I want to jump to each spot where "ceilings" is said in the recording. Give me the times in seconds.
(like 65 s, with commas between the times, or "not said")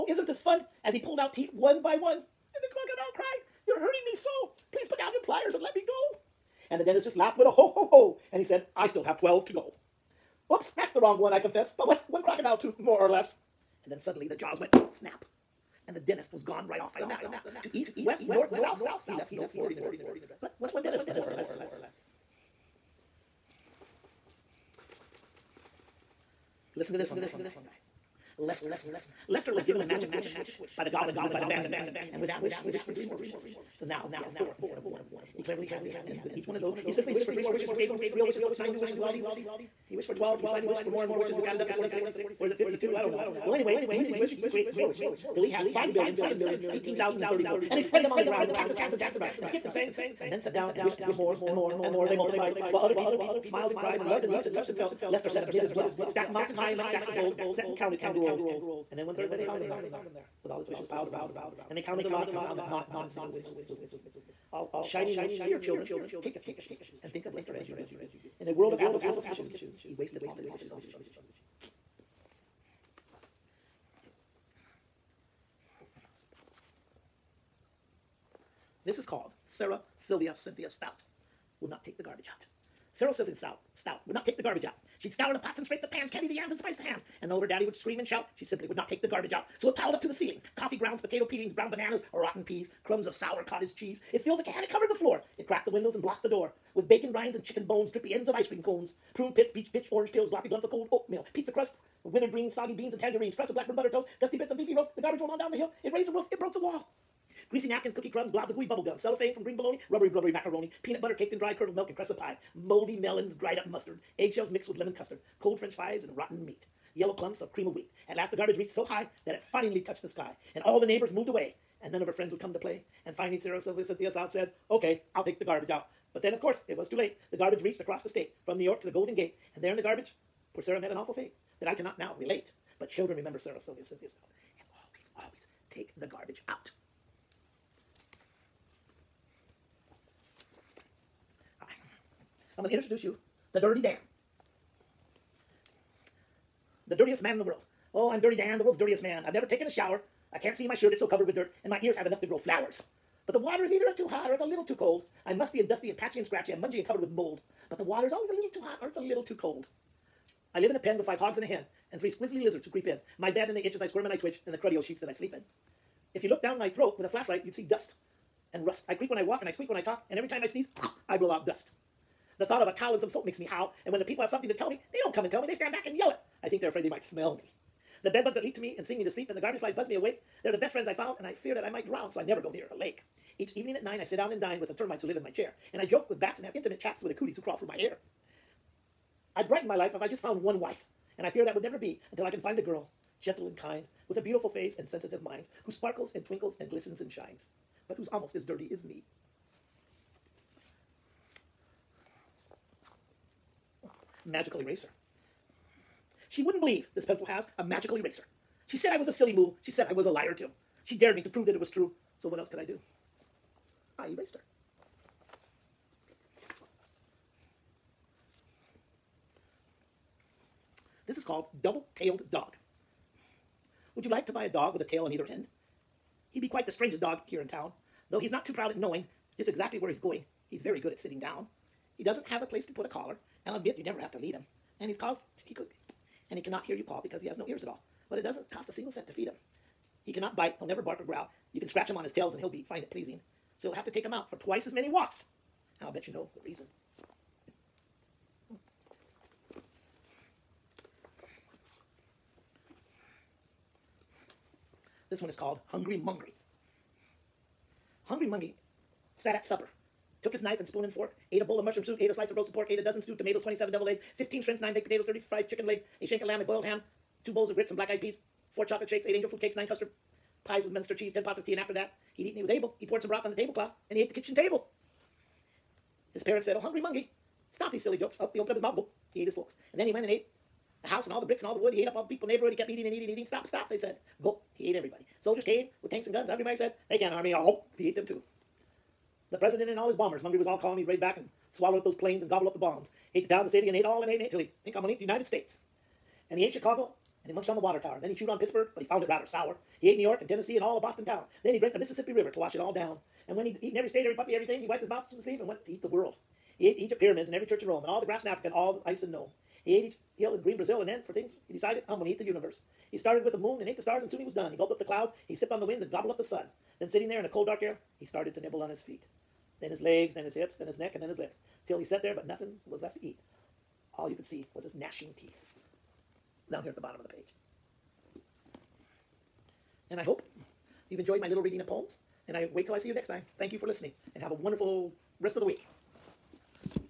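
90 s.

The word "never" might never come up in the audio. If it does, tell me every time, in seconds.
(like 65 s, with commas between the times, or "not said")
149 s, 182 s, 191 s, 233 s, 240 s.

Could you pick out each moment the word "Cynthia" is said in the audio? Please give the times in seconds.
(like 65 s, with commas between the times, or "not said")
80 s, 123 s, 133 s.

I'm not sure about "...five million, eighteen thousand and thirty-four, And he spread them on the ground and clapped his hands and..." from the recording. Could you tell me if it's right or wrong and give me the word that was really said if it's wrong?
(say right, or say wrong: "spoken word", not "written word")
wrong: "seven", not "five".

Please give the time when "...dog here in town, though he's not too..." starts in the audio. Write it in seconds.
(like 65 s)
227 s.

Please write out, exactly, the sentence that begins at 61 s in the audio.
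And they counted the lot and found that not one single wish was missing.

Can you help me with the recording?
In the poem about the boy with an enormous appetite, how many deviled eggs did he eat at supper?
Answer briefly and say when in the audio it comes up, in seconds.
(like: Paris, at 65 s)
27, at 263 s.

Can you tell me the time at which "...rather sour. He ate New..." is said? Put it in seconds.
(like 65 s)
299 s.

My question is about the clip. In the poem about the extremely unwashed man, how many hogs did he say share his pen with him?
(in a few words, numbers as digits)
5.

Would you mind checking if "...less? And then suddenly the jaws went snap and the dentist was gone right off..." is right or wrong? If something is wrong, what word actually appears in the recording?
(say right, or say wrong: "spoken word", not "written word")
right.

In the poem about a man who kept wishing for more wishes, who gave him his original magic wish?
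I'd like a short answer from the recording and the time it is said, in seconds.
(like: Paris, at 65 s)
The goblin, at 30 s.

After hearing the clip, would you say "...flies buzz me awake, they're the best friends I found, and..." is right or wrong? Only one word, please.
right.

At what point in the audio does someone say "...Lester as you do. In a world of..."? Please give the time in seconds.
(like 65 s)
67 s.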